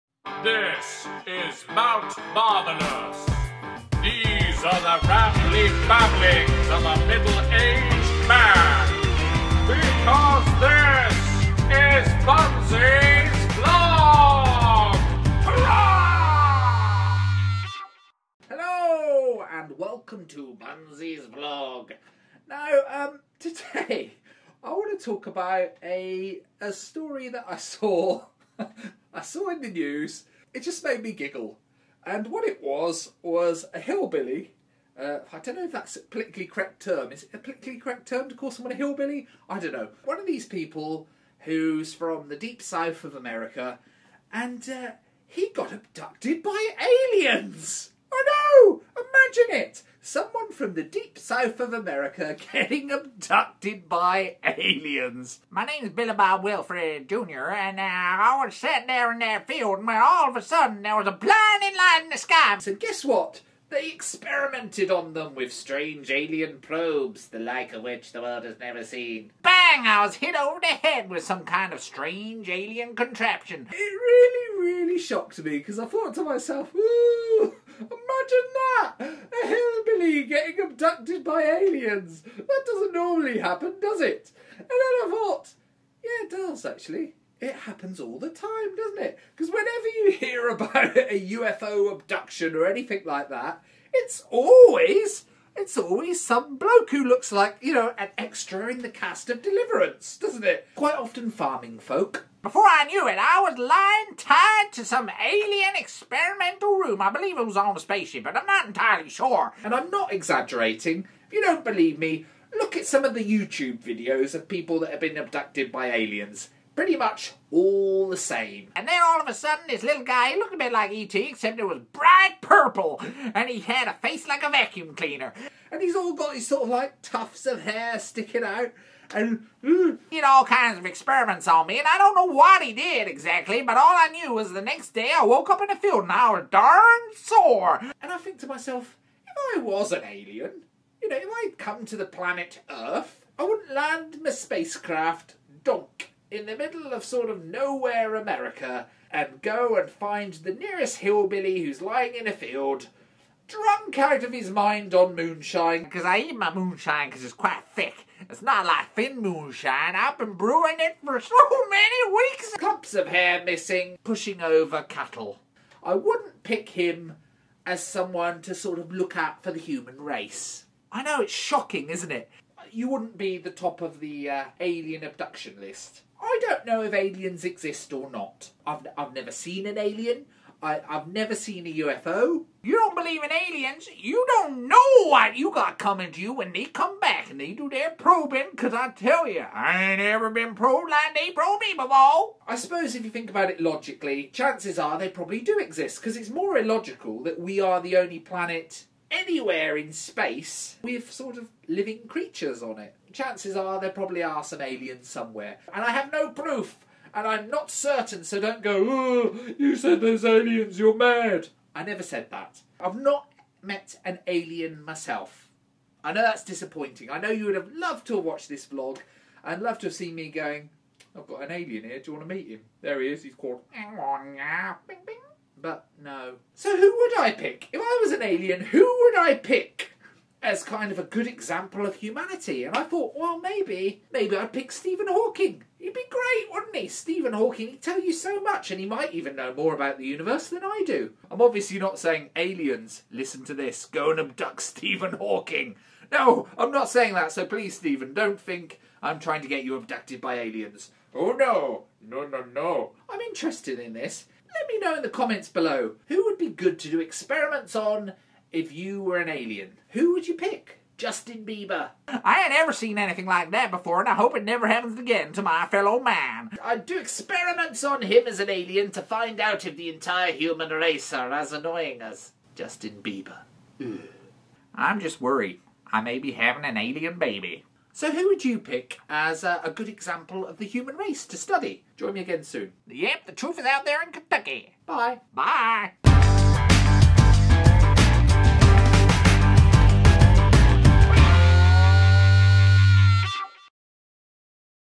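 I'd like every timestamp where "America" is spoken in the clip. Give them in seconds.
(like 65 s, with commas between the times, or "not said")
43 s, 51 s, 148 s.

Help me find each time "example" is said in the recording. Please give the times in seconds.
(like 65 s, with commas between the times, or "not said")
231 s, 279 s.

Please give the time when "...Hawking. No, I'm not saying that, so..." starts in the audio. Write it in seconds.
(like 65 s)
245 s.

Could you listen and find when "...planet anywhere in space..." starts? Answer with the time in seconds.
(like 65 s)
198 s.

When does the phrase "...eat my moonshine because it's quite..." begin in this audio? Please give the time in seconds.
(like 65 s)
156 s.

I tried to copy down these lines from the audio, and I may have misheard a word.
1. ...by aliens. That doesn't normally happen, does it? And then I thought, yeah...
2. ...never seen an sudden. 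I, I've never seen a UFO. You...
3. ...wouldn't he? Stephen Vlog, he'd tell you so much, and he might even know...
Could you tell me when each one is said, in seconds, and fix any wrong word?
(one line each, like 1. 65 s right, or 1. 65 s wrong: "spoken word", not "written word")
1. 81 s right
2. 179 s wrong: "alien", not "sudden"
3. 236 s wrong: "Hawking", not "Vlog".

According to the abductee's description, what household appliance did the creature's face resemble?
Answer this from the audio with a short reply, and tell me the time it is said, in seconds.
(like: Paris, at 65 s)
A vacuum cleaner, at 124 s.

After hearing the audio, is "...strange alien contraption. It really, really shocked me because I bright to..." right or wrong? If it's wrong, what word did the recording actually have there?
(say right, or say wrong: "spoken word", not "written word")
wrong: "thought", not "bright".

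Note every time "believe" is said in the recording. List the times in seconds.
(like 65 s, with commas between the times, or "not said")
107 s, 111 s, 182 s.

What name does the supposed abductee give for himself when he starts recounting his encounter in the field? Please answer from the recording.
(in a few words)
Billabong Wilfred Jr.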